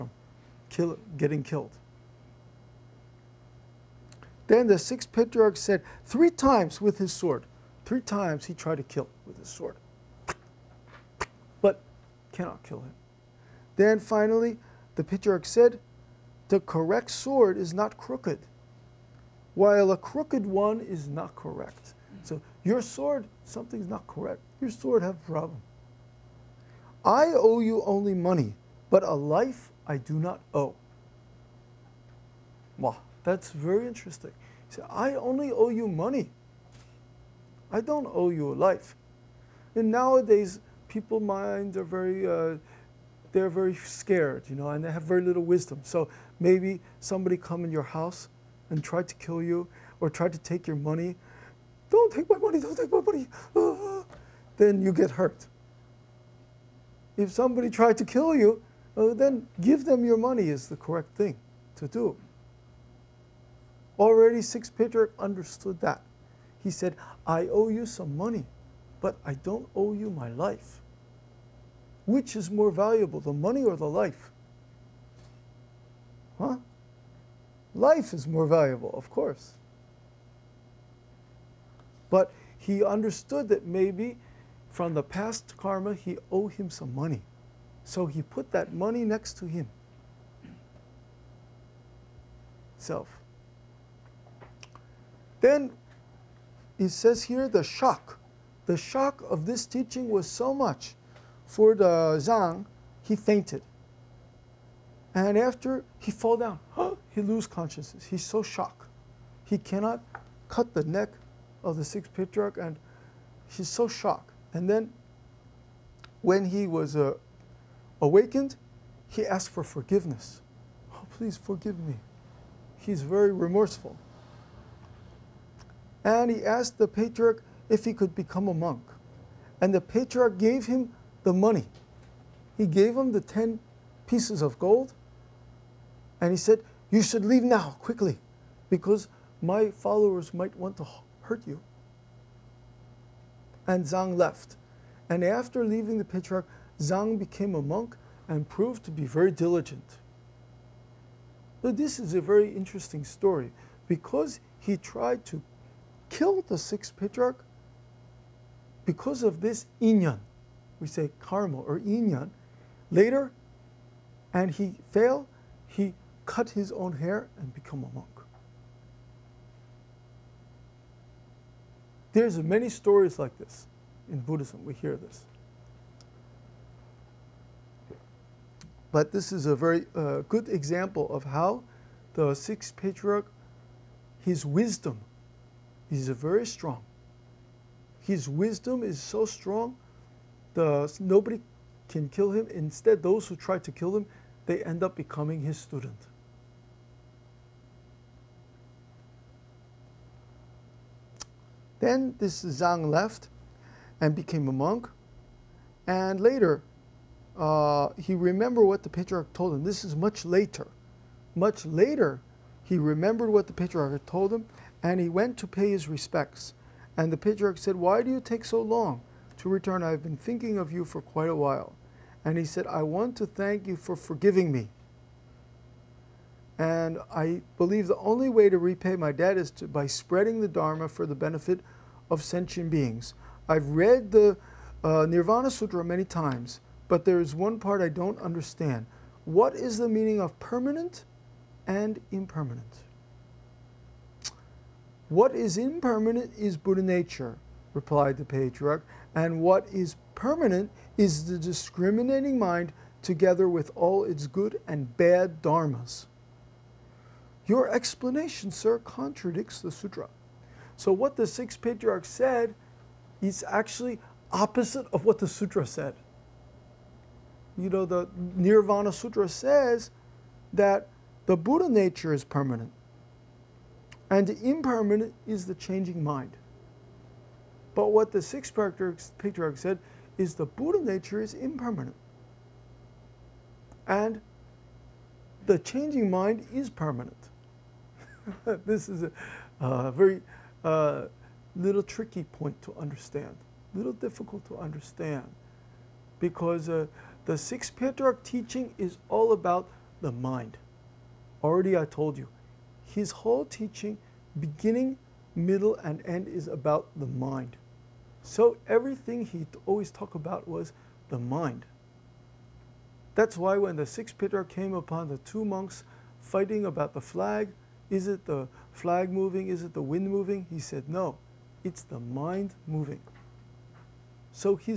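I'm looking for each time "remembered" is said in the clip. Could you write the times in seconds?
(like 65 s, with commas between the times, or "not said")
208 s, 212 s.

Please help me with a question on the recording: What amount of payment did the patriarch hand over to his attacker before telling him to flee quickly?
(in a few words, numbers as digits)
10 pieces of gold.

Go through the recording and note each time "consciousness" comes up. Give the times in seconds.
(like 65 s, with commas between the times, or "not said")
107 s.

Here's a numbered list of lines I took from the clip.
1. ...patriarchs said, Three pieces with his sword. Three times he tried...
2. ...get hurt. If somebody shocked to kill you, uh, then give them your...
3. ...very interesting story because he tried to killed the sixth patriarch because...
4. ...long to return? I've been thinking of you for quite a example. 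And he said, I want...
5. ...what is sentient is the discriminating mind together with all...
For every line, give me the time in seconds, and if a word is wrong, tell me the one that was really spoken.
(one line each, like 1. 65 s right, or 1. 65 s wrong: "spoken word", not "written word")
1. 5 s wrong: "times", not "pieces"
2. 54 s wrong: "tried", not "shocked"
3. 152 s right
4. 218 s wrong: "while", not "example"
5. 249 s wrong: "permanent", not "sentient".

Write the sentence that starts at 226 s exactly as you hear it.
And I believe the only way to repay my debt is to, by spreading the Dharma for the benefit of sentient beings.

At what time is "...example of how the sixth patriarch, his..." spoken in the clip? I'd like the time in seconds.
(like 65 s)
180 s.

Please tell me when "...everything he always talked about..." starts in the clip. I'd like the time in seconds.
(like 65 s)
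308 s.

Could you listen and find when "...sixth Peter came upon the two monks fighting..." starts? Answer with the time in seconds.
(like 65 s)
313 s.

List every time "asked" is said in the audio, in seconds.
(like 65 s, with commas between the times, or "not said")
119 s, 126 s.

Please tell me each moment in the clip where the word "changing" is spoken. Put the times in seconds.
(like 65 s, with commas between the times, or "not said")
275 s, 285 s.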